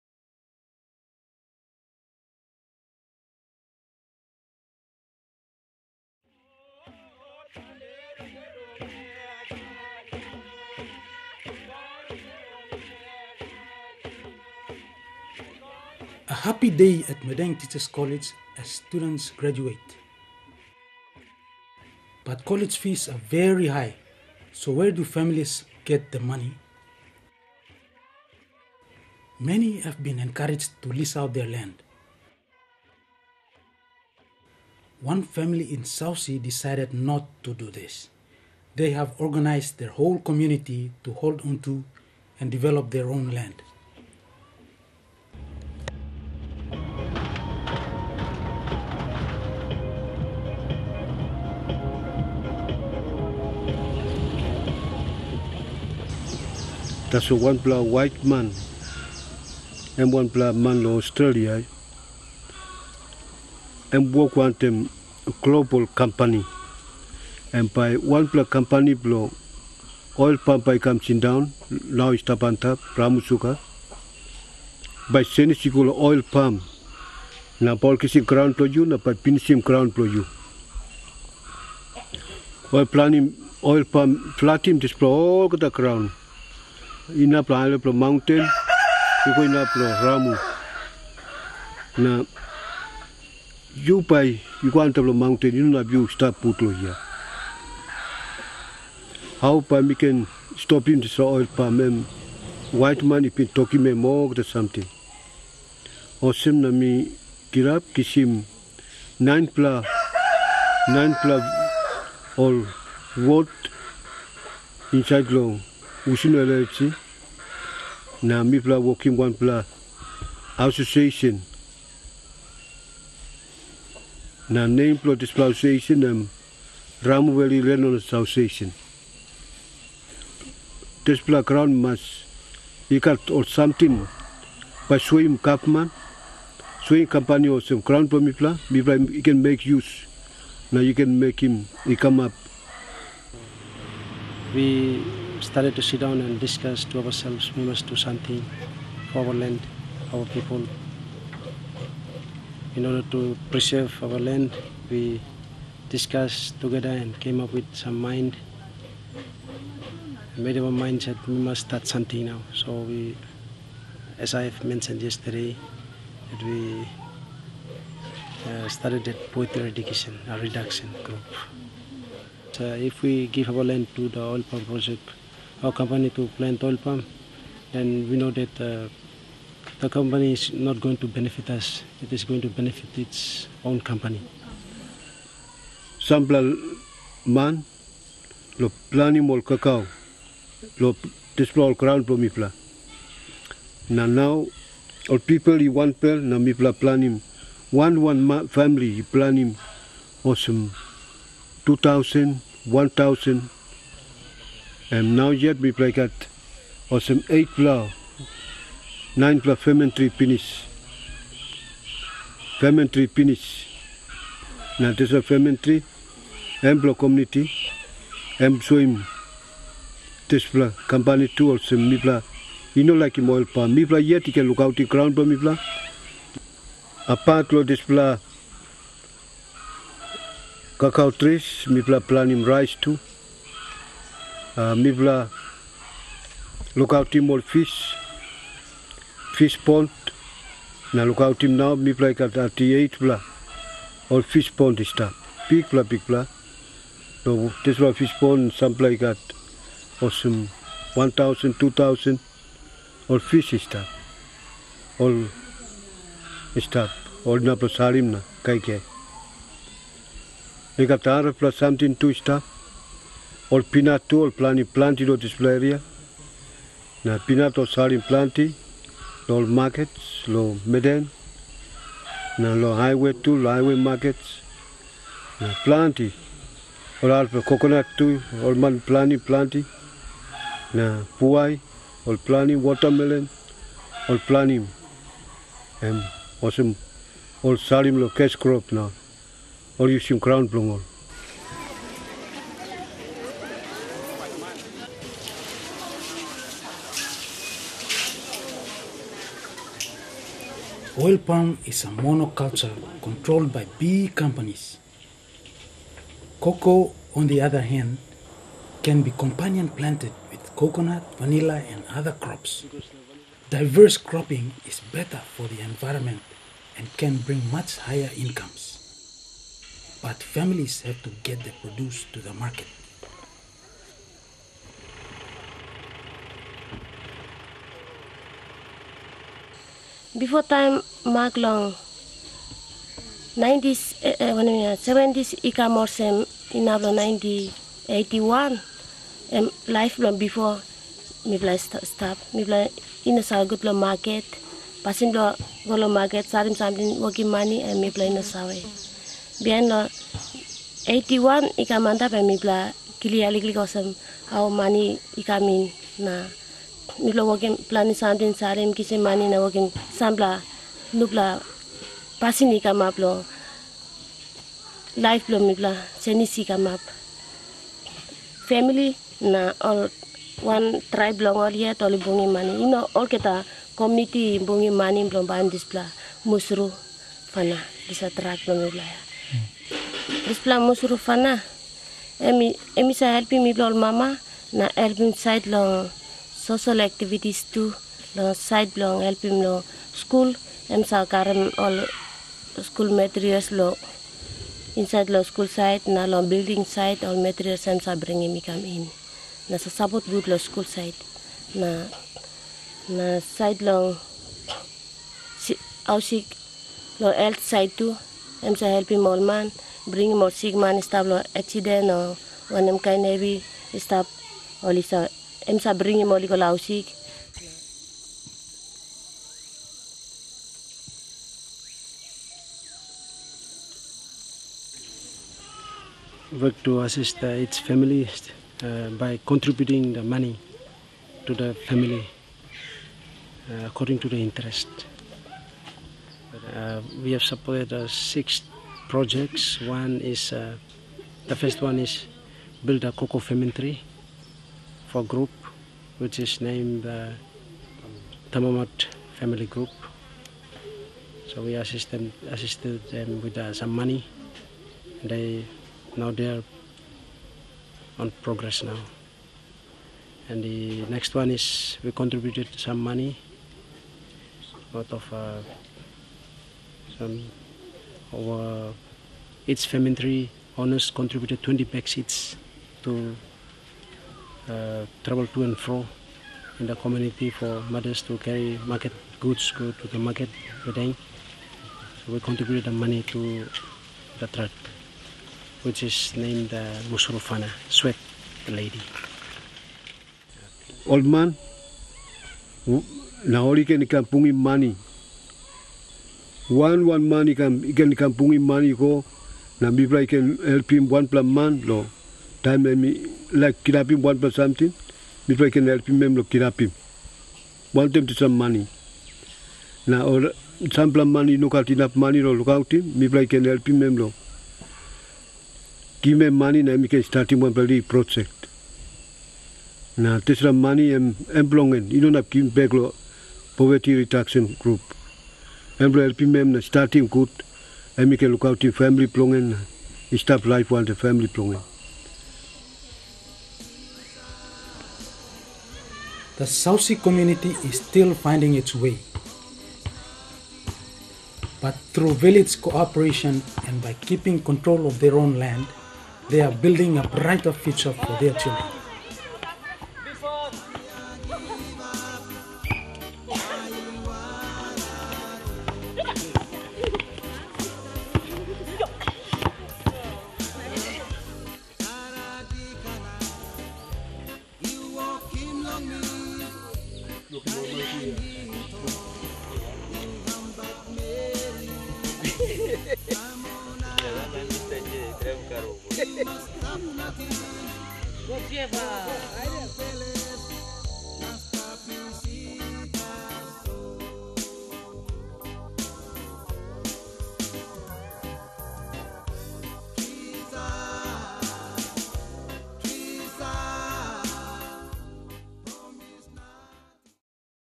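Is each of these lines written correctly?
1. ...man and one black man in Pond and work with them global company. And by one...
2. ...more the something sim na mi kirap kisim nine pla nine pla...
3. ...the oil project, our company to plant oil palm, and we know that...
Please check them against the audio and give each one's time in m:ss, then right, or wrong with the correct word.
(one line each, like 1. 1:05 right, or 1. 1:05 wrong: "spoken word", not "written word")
1. 0:58 wrong: "Australia", not "Pond"
2. 1:43 right
3. 2:54 right.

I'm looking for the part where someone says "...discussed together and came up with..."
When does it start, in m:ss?
2:35.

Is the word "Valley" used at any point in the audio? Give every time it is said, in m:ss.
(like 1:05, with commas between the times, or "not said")
2:07.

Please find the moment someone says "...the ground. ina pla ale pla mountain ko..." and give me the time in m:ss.
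1:25.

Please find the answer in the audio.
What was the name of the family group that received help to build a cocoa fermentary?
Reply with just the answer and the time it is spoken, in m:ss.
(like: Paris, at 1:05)
Tamamat Family Group, at 7:28.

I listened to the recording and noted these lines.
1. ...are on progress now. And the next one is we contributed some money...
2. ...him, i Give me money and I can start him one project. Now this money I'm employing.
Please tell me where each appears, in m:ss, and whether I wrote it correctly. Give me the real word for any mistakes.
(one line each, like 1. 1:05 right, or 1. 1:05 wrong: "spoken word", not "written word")
1. 7:36 right
2. 8:33 right.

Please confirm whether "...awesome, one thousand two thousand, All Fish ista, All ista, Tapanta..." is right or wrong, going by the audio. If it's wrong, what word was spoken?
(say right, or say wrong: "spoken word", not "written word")
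wrong: "All", not "Tapanta".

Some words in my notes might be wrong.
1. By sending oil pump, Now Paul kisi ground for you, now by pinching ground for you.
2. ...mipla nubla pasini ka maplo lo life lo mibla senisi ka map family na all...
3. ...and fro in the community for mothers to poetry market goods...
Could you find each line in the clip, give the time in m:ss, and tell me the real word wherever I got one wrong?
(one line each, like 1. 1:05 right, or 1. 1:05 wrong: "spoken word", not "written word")
1. 1:15 right
2. 5:59 wrong: "sambla", not "mipla"
3. 7:55 wrong: "carry", not "poetry".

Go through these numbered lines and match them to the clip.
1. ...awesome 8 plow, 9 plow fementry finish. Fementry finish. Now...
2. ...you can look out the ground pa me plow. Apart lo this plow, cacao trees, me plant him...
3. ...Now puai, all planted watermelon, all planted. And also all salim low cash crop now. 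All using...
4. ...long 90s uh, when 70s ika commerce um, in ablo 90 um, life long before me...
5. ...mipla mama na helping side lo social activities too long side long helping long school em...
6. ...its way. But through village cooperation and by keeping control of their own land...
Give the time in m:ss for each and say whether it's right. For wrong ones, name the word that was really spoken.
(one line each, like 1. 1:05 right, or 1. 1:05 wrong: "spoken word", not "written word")
1. 3:26 right
2. 3:44 right
3. 4:40 right
4. 5:31 right
5. 6:23 wrong: "mibla", not "mipla"
6. 8:58 right.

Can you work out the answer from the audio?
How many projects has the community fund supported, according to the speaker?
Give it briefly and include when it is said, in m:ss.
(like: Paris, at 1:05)
6, at 7:17.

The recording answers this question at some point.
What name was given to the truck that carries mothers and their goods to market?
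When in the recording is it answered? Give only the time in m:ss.
8:06.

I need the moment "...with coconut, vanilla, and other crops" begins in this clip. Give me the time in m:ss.
5:10.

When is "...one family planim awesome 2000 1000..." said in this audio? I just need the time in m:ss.
3:18.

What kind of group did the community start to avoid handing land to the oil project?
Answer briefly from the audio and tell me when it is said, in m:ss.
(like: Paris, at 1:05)
poverty reduction group, at 2:49.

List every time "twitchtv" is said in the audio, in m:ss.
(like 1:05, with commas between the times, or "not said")
not said.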